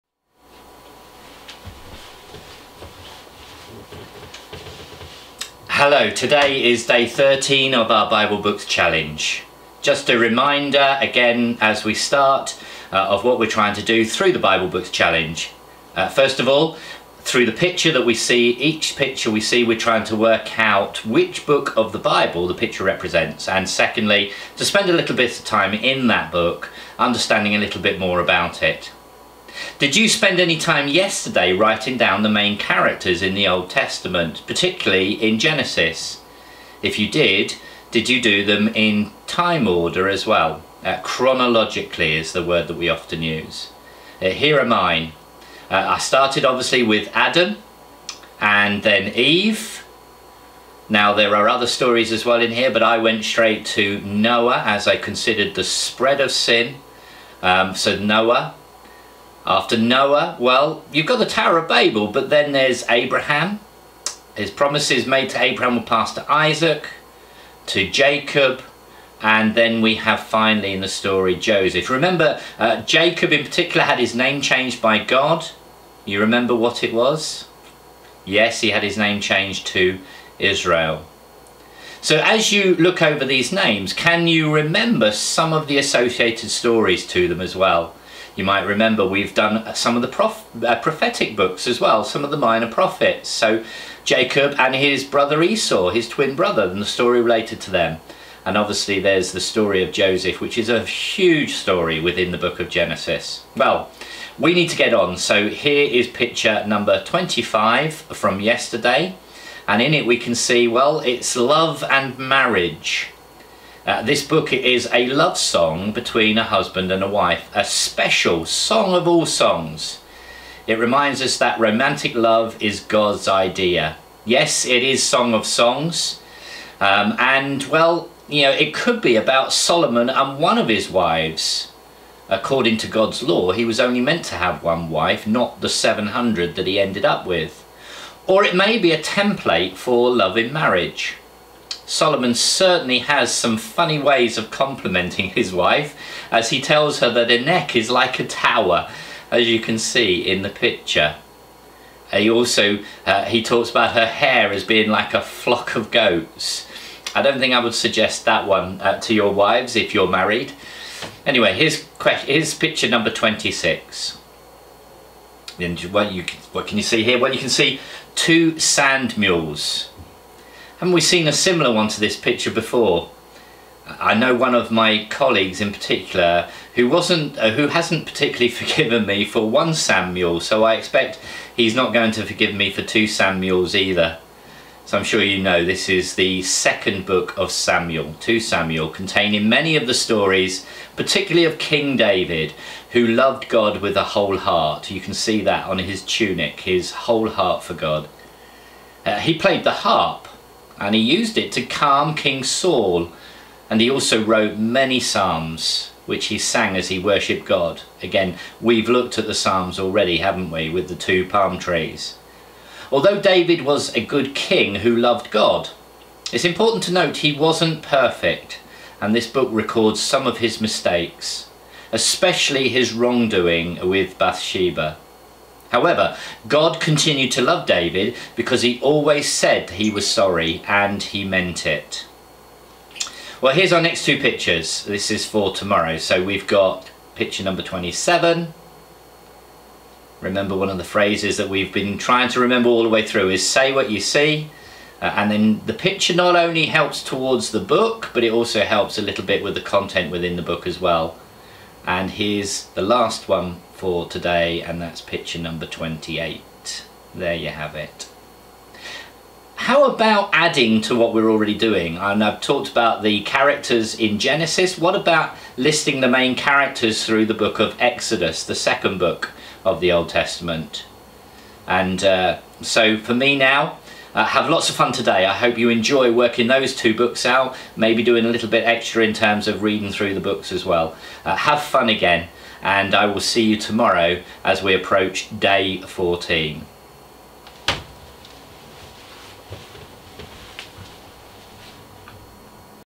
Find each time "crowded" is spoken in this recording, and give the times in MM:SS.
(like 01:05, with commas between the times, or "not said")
not said.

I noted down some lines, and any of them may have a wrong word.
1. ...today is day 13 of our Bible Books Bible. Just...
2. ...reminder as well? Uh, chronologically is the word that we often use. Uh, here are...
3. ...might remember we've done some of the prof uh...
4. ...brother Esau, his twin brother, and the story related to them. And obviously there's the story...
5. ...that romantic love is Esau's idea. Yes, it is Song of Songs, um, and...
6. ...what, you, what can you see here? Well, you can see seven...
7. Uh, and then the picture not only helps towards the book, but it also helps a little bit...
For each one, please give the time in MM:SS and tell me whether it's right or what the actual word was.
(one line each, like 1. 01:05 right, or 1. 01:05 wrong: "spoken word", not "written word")
1. 00:06 wrong: "Challenge", not "Bible"
2. 00:39 wrong: "order", not "reminder"
3. 01:28 right
4. 01:35 right
5. 02:01 wrong: "God", not "Esau"
6. 02:45 wrong: "two", not "seven"
7. 04:05 right.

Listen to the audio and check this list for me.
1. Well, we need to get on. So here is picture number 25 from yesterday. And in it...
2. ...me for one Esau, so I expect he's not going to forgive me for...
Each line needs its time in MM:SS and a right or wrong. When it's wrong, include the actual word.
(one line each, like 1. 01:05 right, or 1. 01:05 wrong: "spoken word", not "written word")
1. 01:43 right
2. 02:59 wrong: "Samuel", not "Esau".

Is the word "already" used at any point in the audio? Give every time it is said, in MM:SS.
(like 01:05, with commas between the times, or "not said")
03:29, 04:21.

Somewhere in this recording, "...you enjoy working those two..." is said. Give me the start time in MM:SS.
04:35.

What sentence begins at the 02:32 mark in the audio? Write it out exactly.
Uh, he also, uh, he talks about her hair as being like a flock of goats.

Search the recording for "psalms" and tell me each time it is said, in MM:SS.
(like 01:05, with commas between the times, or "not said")
03:24, 03:29.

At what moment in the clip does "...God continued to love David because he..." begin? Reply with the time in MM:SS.
03:46.